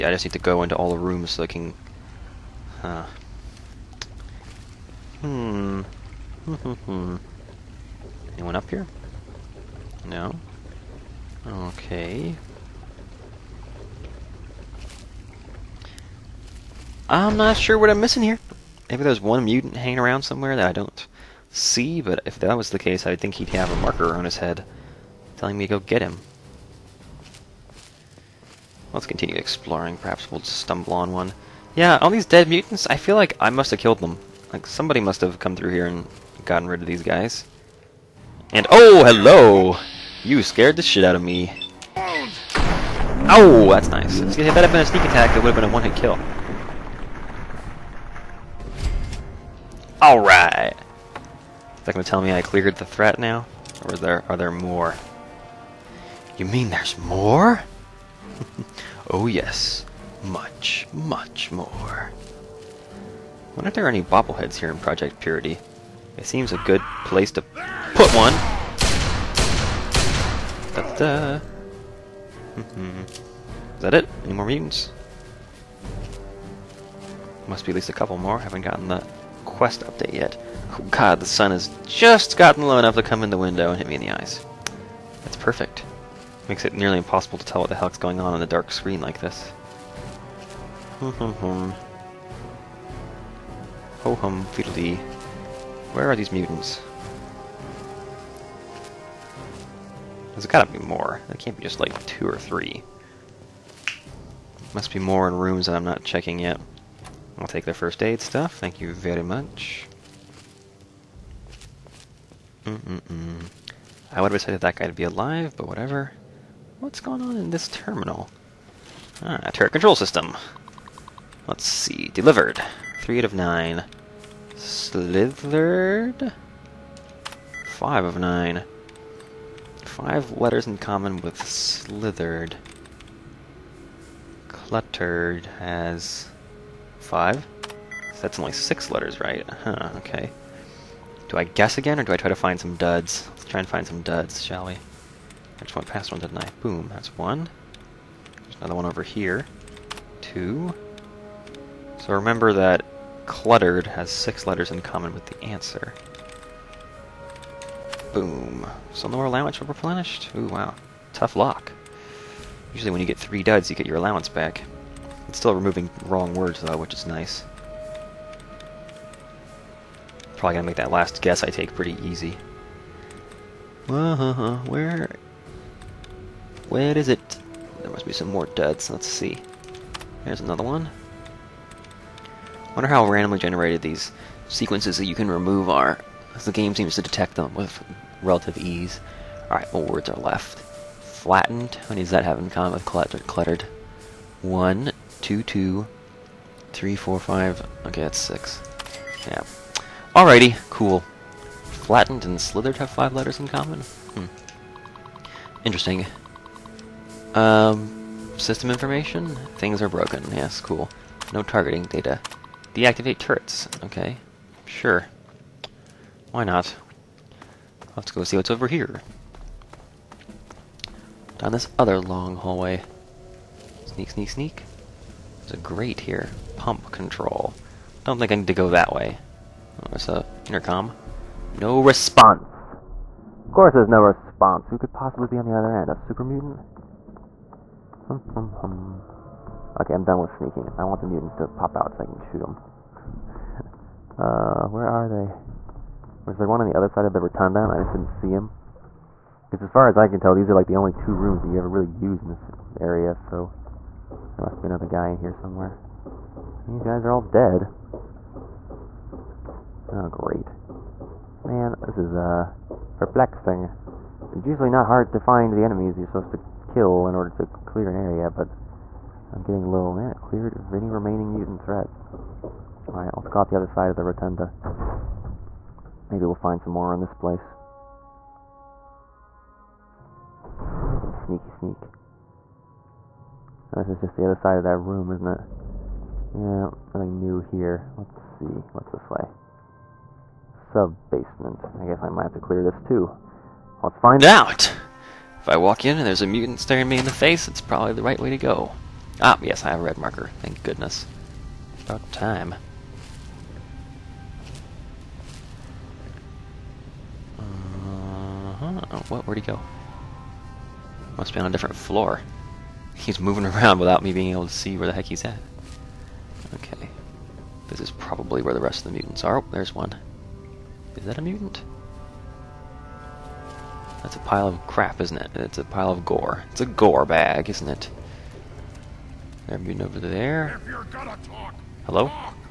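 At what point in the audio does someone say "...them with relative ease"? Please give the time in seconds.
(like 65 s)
187 s.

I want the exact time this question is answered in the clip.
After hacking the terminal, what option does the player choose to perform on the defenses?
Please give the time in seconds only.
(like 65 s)
212 s.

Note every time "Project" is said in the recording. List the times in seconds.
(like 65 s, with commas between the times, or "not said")
64 s.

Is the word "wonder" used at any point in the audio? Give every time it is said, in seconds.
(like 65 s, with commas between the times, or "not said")
63 s, 182 s.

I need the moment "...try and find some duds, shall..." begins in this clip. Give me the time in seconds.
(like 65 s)
143 s.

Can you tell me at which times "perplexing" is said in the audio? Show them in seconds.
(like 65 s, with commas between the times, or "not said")
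262 s.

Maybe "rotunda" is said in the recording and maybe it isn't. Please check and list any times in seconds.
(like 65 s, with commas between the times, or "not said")
247 s, 274 s.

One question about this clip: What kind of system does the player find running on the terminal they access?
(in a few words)
Turret control system.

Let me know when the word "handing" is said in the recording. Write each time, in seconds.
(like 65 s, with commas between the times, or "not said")
not said.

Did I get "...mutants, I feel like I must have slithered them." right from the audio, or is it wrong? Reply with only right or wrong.
wrong.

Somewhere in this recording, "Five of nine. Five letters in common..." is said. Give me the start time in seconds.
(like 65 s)
127 s.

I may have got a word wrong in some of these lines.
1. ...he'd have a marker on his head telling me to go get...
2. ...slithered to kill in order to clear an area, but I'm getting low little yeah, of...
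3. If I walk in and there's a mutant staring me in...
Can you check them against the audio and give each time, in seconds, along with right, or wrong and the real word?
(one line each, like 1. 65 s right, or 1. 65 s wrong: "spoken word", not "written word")
1. 23 s right
2. 266 s wrong: "supposed", not "slithered"
3. 295 s right.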